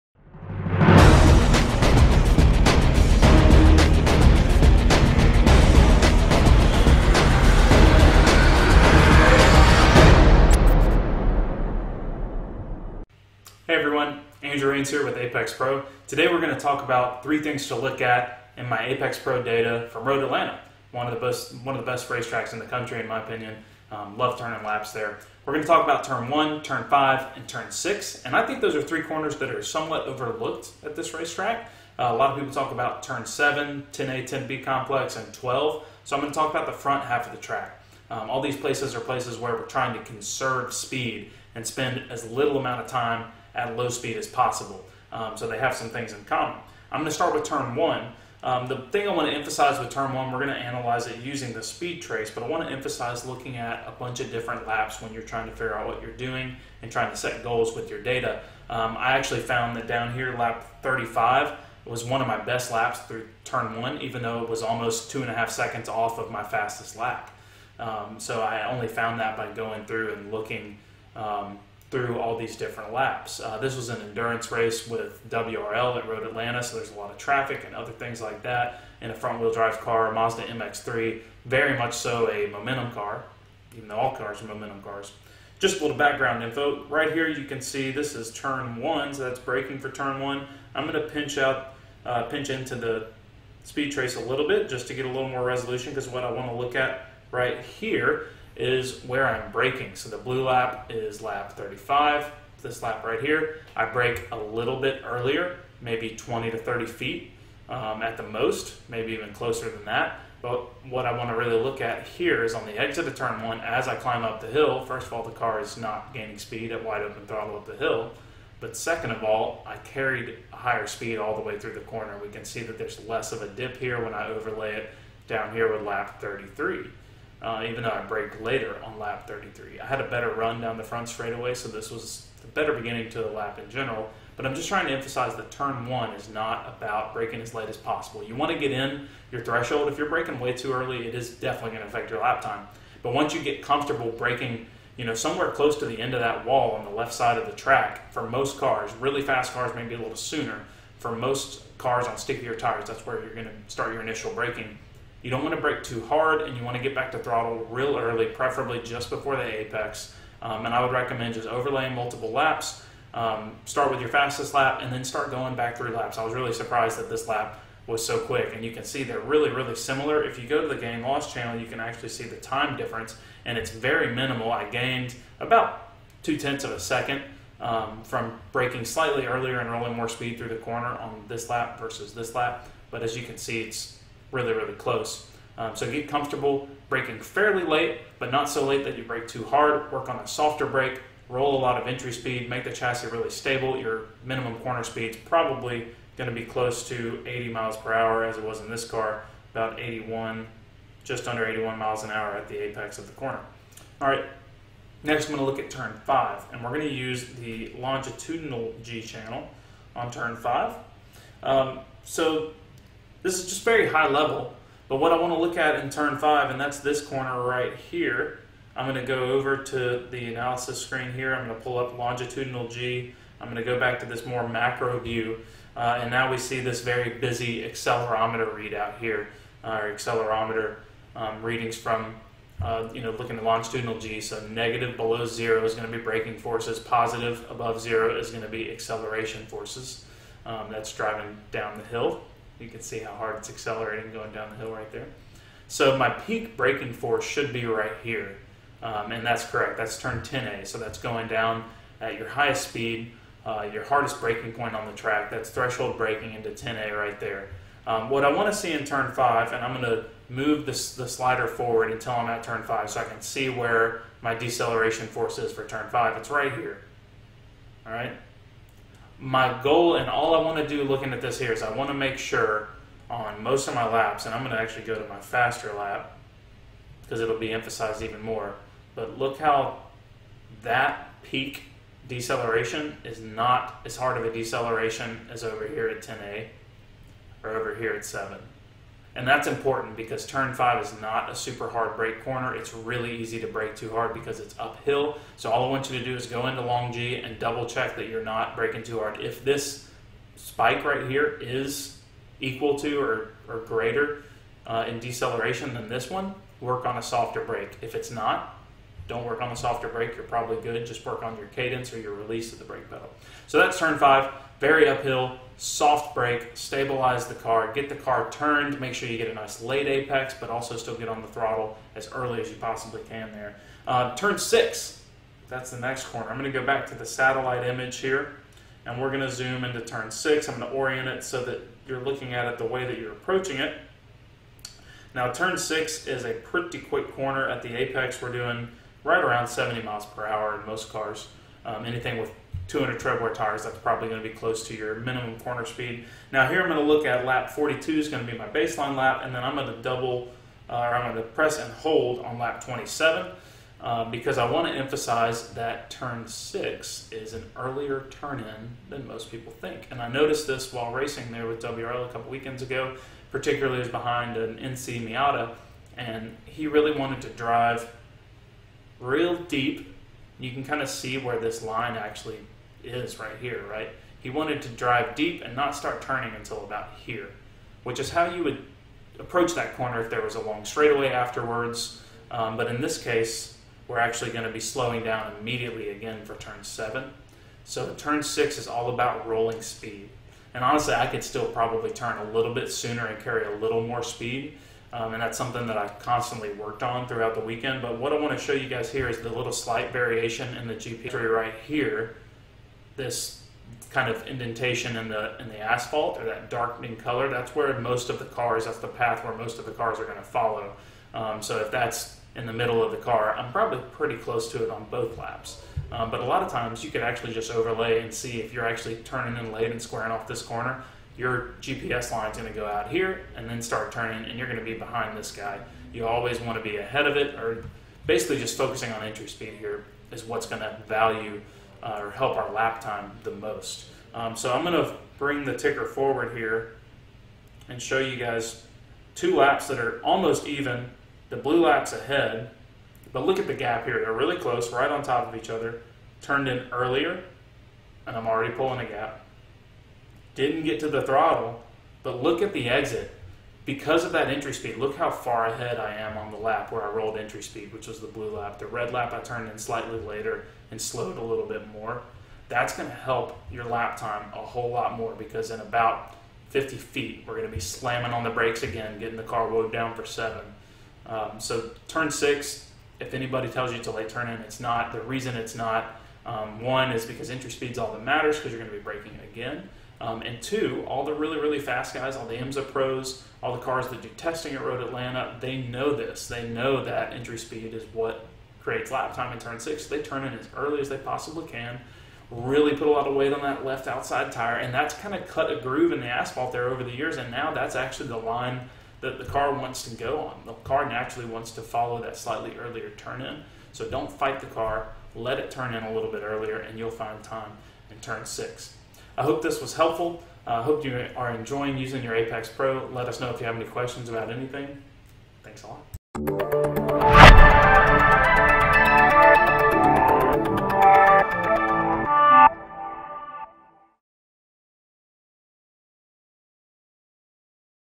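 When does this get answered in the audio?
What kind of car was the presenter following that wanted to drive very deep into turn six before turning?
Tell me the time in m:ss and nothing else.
6:04.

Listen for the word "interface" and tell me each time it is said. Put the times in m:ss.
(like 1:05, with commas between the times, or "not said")
not said.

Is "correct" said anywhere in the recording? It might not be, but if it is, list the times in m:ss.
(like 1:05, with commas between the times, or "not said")
4:09.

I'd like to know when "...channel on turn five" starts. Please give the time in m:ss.
3:29.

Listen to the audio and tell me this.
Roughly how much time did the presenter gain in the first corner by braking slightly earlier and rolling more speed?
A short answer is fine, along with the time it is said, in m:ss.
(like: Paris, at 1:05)
two tenths of a second, at 2:56.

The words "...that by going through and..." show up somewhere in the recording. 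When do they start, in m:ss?
1:09.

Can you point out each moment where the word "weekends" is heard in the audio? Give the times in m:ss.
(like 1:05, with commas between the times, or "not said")
6:02, 6:37.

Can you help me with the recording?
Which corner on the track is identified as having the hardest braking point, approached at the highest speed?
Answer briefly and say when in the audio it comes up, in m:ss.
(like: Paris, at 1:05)
10A, at 4:09.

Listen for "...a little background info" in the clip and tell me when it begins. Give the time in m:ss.
1:25.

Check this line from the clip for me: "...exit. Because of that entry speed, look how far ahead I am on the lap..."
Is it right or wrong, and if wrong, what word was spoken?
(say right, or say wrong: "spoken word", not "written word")
right.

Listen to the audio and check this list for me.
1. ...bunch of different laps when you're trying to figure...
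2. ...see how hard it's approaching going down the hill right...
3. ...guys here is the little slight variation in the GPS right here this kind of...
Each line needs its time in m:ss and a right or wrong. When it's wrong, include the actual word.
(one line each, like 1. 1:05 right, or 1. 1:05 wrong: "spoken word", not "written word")
1. 0:53 right
2. 4:02 wrong: "accelerating", not "approaching"
3. 6:38 right.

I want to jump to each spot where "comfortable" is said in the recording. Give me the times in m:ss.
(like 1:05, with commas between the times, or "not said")
2:23, 3:06.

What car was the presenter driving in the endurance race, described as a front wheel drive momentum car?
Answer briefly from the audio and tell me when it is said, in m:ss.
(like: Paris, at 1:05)
Mazda MX3, at 1:20.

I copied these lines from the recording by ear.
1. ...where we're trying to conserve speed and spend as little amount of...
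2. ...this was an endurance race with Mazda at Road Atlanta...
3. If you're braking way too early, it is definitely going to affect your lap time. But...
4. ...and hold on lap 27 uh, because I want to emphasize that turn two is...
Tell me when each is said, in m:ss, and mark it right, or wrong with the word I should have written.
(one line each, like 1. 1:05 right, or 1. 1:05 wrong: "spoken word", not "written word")
1. 0:39 right
2. 1:13 wrong: "WRL", not "Mazda"
3. 2:19 right
4. 5:51 wrong: "six", not "two".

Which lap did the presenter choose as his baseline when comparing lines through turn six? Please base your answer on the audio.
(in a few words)
42.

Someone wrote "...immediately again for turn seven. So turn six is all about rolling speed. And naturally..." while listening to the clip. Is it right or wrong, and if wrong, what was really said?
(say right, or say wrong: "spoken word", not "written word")
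wrong: "honestly", not "naturally".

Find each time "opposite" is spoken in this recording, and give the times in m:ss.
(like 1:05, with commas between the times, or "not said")
not said.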